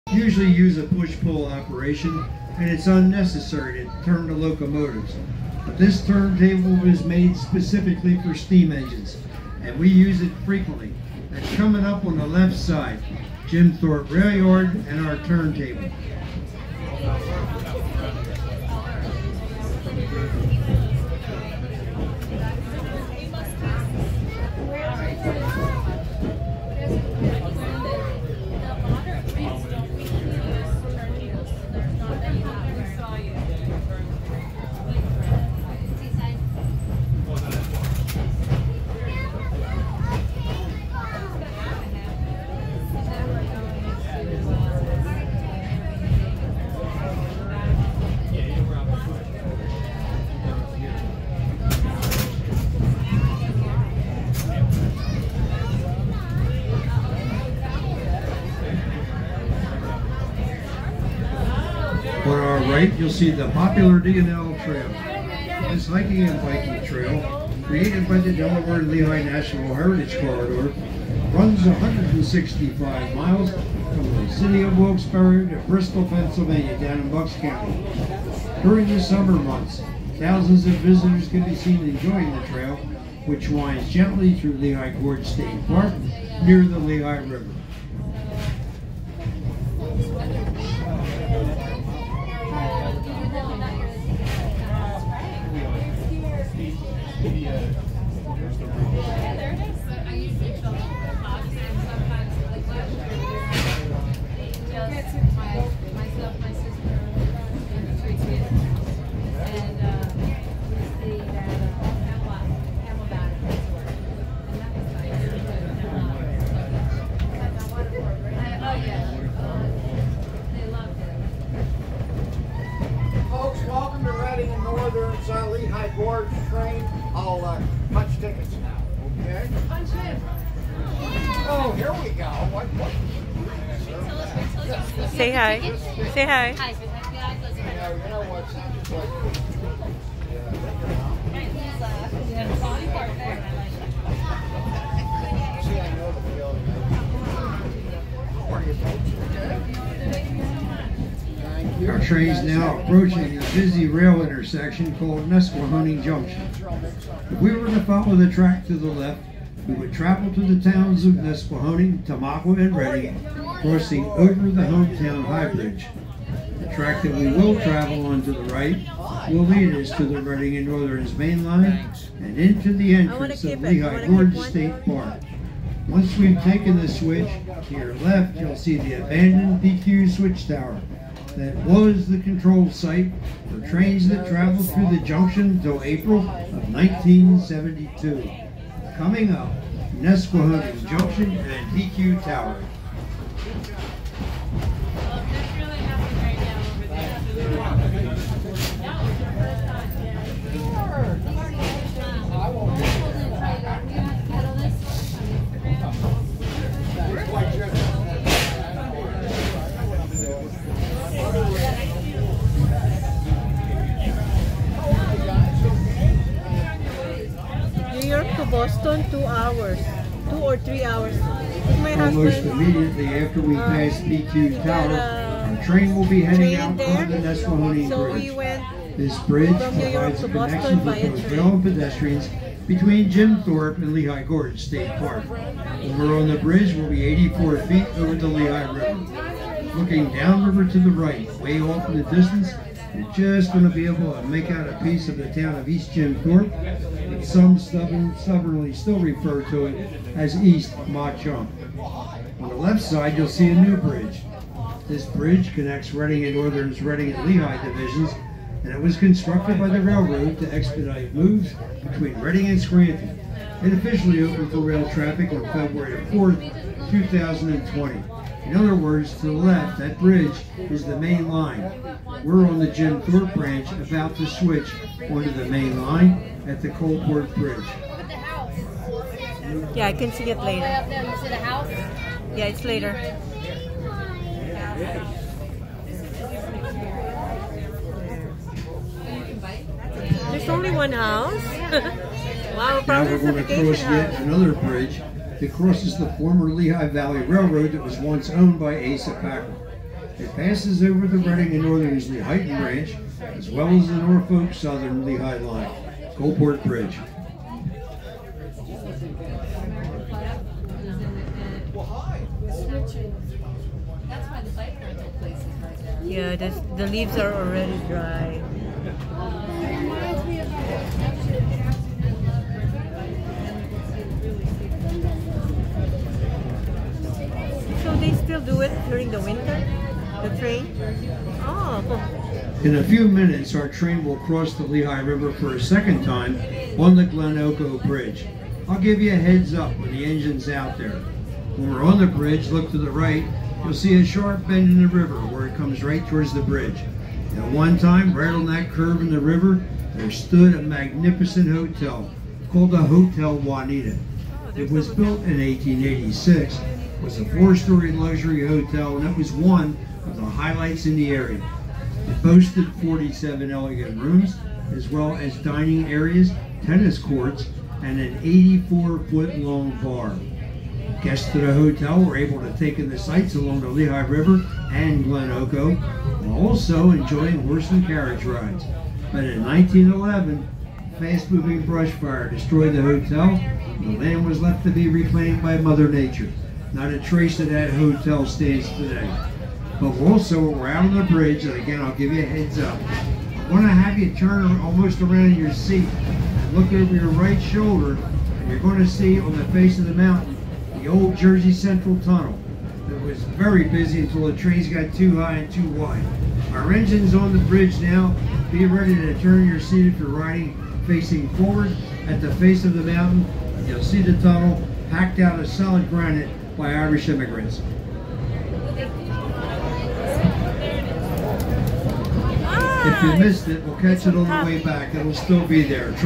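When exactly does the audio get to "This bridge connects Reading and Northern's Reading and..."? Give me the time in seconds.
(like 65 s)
254 s.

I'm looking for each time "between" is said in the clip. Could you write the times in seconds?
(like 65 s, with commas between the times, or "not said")
232 s, 261 s.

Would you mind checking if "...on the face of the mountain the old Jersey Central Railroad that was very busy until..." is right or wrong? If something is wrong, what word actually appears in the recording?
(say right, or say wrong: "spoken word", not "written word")
wrong: "Tunnel", not "Railroad".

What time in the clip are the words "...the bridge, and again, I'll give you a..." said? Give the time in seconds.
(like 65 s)
390 s.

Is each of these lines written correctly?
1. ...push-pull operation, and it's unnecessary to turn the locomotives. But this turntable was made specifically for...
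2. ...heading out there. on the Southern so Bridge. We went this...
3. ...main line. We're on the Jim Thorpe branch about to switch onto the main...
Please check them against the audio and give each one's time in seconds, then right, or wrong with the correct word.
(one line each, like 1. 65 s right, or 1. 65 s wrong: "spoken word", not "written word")
1. 0 s right
2. 226 s wrong: "Nesquehoning", not "Southern"
3. 270 s right.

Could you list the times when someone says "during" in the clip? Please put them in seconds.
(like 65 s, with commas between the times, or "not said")
78 s, 328 s.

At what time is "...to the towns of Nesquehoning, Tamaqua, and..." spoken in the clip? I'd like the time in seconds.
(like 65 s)
160 s.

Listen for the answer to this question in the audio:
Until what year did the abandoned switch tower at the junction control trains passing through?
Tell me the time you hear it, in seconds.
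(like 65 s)
185 s.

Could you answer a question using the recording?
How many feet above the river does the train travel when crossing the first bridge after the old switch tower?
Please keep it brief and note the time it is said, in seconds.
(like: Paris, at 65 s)
84 feet, at 237 s.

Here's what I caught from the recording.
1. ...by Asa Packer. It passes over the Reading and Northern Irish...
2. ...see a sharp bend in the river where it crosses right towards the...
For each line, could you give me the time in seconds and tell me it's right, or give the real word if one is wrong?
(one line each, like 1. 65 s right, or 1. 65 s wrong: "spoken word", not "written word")
1. 298 s wrong: "Lehighton", not "Irish"
2. 343 s wrong: "comes", not "crosses".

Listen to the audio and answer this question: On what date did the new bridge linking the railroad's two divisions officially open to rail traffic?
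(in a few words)
February 4, 2020.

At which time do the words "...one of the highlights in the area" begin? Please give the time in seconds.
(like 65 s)
359 s.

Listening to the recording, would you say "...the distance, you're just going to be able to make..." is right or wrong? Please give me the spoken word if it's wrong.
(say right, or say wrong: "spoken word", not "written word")
right.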